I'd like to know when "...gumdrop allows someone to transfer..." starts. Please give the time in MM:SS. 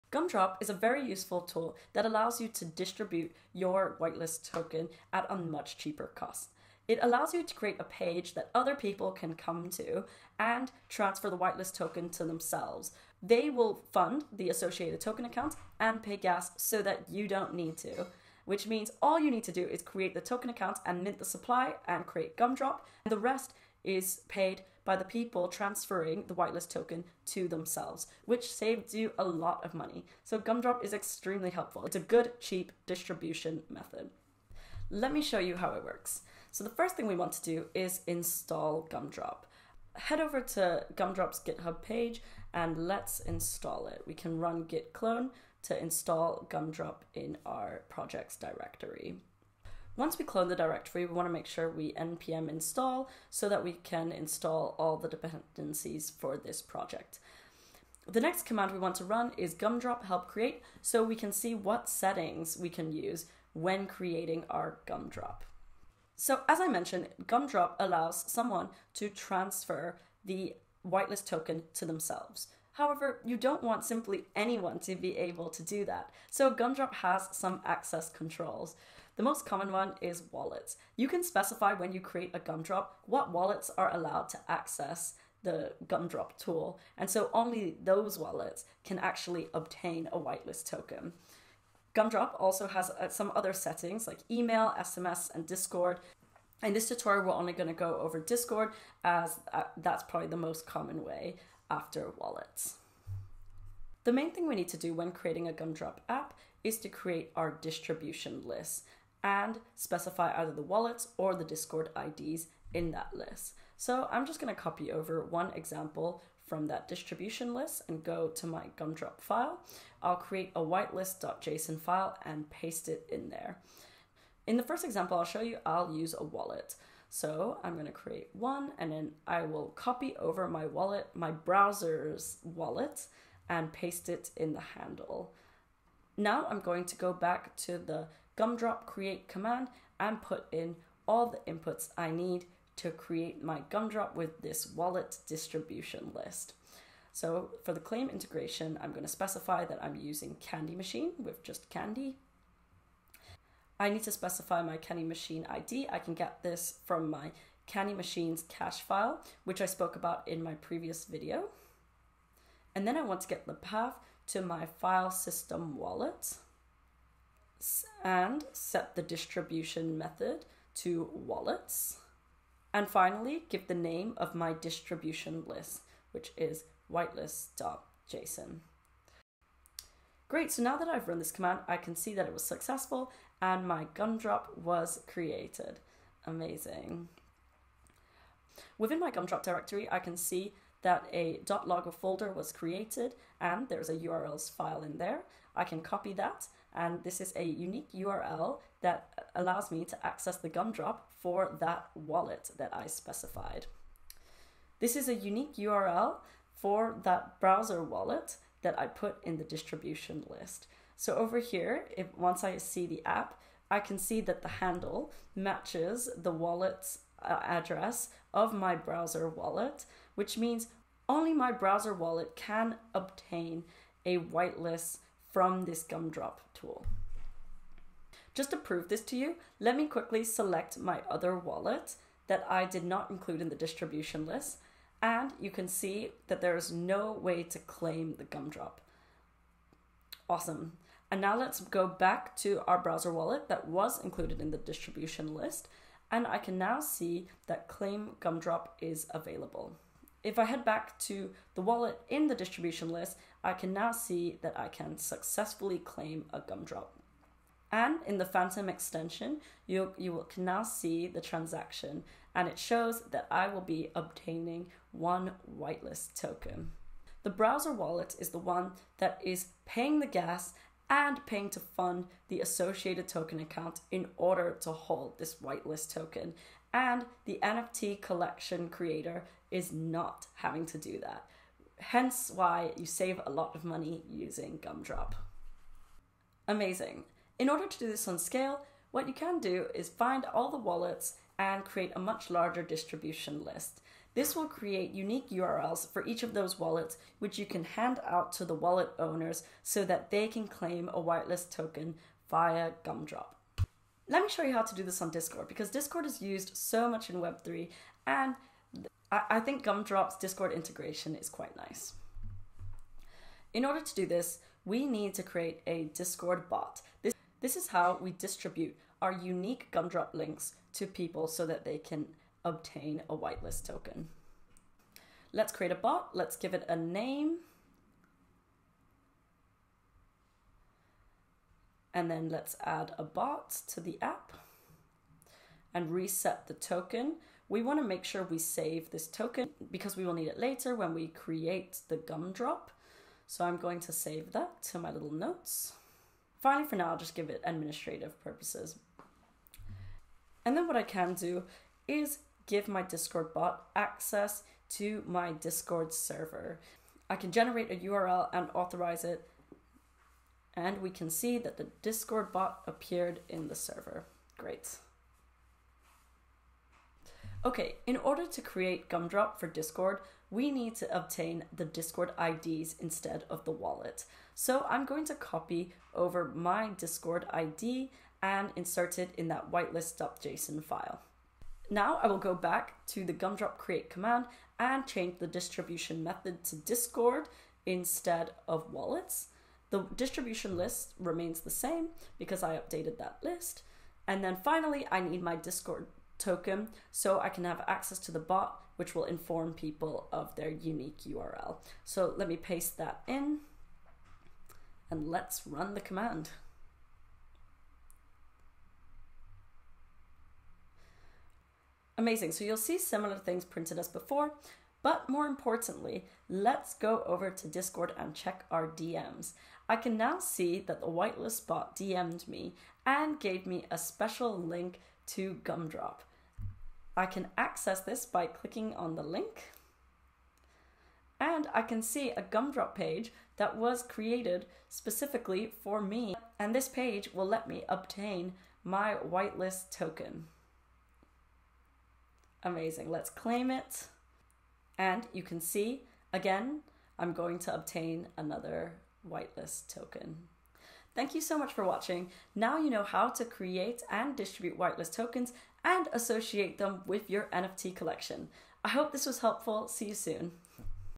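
01:07.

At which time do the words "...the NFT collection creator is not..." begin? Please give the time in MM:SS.
04:37.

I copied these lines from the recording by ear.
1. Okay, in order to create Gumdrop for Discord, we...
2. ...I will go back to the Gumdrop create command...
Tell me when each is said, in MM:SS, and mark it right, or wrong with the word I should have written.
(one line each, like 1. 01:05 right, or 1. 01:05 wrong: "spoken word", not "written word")
1. 06:07 right
2. 06:22 right.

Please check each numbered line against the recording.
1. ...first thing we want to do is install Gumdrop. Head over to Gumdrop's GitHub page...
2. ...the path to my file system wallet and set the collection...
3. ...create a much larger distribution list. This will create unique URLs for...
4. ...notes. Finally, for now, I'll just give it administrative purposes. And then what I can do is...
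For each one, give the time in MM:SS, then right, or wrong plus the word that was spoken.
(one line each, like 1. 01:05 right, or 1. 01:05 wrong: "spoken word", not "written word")
1. 00:36 right
2. 02:43 wrong: "distribution", not "collection"
3. 04:51 right
4. 05:45 right.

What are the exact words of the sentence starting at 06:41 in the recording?
So let me paste that in and let's run the command.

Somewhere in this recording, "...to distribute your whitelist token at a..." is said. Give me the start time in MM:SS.
00:02.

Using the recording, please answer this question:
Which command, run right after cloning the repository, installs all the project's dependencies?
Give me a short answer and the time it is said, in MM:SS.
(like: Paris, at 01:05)
npm install, at 00:51.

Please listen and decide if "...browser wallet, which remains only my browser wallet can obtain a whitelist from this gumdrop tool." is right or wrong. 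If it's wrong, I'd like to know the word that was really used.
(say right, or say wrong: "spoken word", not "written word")
wrong: "means", not "remains".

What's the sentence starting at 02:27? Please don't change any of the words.
So for the claim integration, I'm going to specify that I'm using Candy Machine with just Candy.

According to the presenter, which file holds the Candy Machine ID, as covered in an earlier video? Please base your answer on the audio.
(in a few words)
cache file.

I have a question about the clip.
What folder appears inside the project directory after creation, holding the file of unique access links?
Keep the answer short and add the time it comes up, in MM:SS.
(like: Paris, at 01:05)
.logger, at 03:11.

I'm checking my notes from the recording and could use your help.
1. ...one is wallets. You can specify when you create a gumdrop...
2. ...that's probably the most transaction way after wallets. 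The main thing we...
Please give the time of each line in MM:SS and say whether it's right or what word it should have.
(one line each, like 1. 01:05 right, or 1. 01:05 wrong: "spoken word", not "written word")
1. 01:19 right
2. 01:39 wrong: "common", not "transaction".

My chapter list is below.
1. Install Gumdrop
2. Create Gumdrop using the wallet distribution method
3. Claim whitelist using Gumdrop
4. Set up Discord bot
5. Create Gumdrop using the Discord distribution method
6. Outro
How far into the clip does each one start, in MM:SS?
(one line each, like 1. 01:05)
1. 00:34
2. 01:43
3. 03:24
4. 05:03
5. 06:06
6. 07:30.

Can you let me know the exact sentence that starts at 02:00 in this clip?
I'll create a whitelist.json file and paste it in there.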